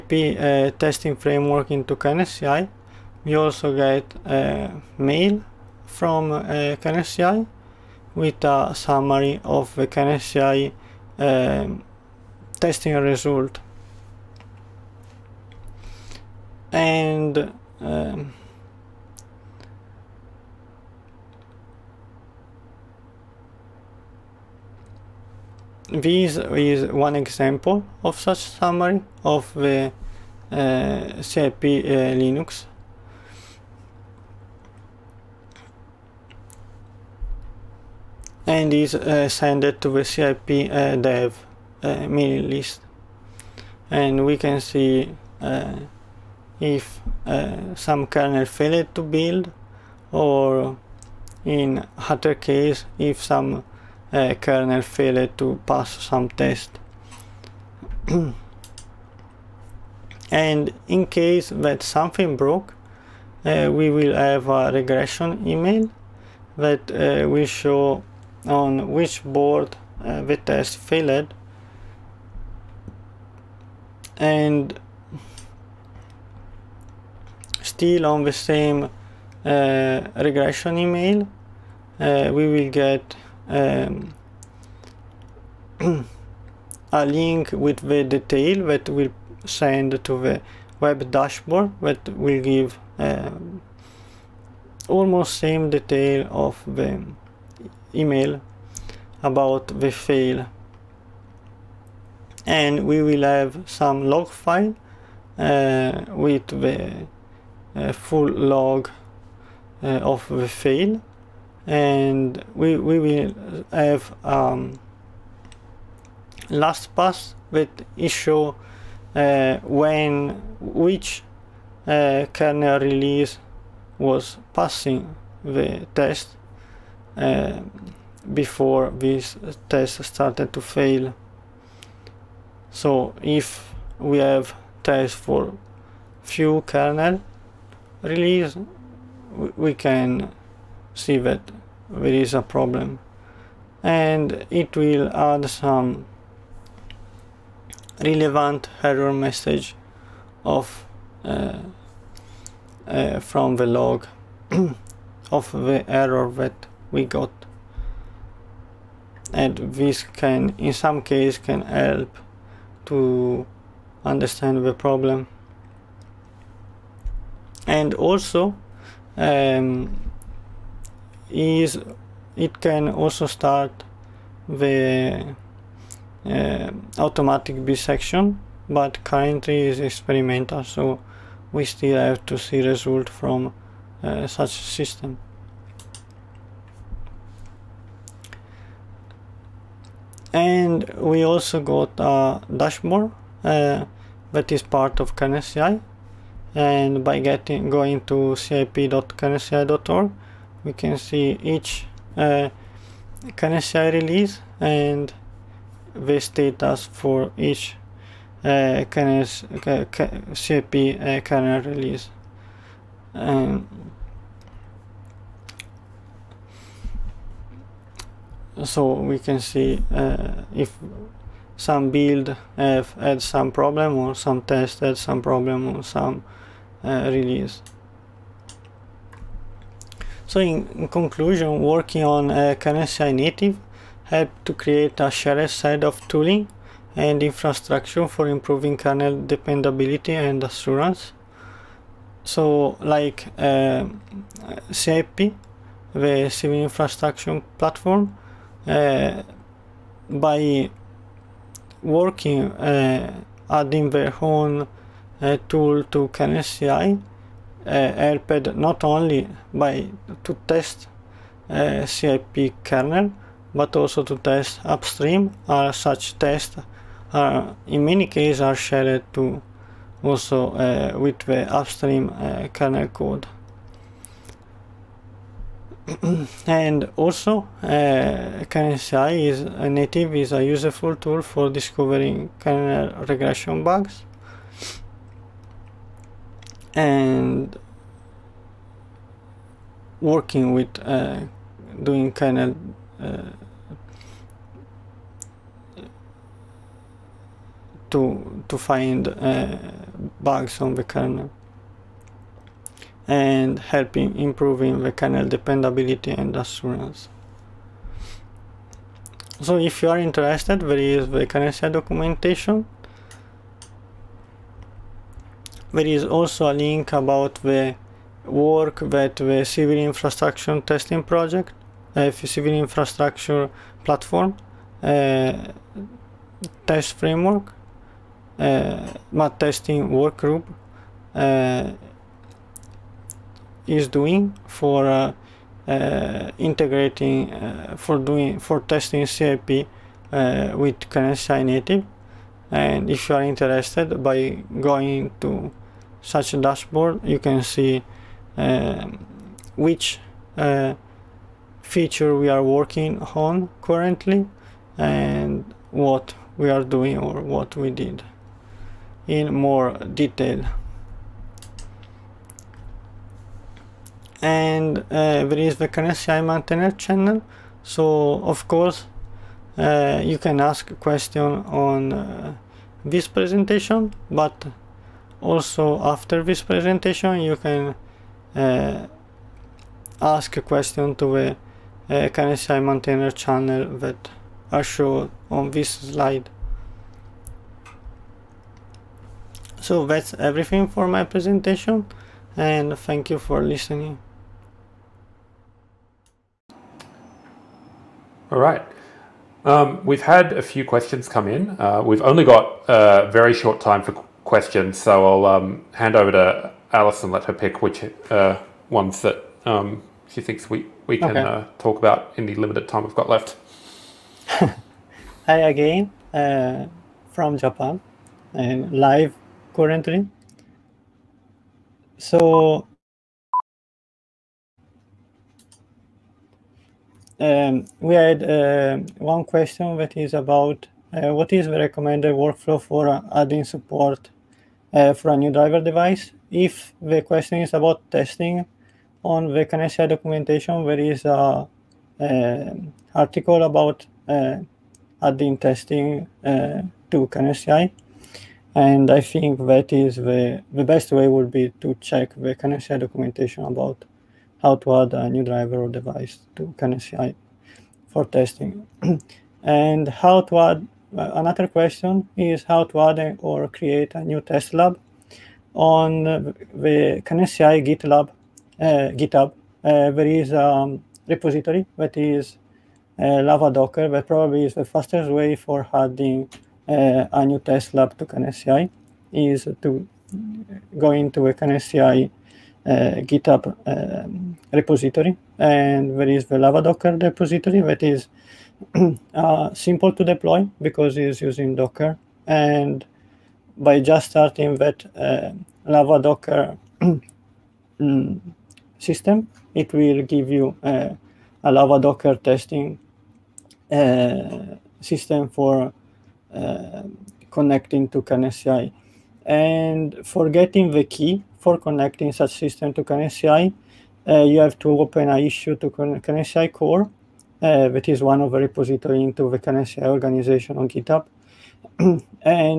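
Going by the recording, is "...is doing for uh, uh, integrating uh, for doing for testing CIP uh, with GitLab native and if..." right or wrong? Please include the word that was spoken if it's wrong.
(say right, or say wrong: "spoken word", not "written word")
wrong: "KernelCI", not "GitLab".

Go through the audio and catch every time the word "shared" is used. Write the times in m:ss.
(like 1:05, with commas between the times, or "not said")
3:55, 4:28.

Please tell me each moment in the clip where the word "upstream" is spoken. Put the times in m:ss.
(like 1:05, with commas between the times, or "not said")
4:24, 4:31.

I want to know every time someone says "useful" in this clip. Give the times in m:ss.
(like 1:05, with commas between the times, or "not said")
4:40.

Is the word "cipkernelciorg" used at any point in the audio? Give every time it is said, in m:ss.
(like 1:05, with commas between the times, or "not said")
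3:18.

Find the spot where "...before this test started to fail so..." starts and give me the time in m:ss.
2:08.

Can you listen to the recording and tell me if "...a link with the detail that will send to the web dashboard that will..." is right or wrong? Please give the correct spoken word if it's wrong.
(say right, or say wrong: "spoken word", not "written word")
right.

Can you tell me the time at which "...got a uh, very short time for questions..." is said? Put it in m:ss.
6:42.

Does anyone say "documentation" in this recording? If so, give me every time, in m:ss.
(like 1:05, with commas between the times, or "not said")
5:11, 7:19, 7:32.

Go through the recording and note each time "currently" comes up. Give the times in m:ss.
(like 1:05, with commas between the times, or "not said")
2:59, 5:53, 6:59.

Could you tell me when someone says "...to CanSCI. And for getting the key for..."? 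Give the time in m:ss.
8:27.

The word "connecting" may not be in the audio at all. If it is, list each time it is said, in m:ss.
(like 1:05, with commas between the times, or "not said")
8:27, 8:31.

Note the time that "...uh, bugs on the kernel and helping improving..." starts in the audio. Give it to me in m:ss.
4:59.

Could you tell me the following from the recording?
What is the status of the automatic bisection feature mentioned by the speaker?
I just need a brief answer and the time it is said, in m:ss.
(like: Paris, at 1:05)
Experimental, at 2:59.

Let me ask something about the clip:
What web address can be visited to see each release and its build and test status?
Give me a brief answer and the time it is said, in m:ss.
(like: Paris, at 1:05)
cip.kernelci.org, at 3:18.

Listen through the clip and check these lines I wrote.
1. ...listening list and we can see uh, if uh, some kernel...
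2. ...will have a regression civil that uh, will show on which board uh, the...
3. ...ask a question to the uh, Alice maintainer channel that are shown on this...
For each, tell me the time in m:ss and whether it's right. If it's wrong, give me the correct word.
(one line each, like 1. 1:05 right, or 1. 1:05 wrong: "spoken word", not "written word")
1. 0:42 wrong: "mailing", not "listening"
2. 1:03 wrong: "email", not "civil"
3. 6:20 wrong: "KernelCI", not "Alice".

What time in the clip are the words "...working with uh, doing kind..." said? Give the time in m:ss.
4:50.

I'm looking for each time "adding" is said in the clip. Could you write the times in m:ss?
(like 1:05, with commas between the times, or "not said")
4:13, 7:13, 7:25, 7:55.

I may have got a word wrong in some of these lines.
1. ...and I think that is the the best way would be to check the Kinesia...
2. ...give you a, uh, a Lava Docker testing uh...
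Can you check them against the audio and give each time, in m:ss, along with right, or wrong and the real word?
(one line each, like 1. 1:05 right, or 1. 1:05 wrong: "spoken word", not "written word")
1. 7:28 right
2. 8:20 right.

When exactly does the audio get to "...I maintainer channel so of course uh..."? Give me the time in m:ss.
6:06.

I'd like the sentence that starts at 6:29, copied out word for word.
So that's everything for my presentation and thank you for listening.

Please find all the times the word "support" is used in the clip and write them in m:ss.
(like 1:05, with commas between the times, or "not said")
7:13.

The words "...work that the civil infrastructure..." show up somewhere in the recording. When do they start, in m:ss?
5:18.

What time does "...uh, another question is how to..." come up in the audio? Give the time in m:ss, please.
7:40.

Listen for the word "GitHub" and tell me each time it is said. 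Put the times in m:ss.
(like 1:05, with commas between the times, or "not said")
7:48, 8:02, 8:40.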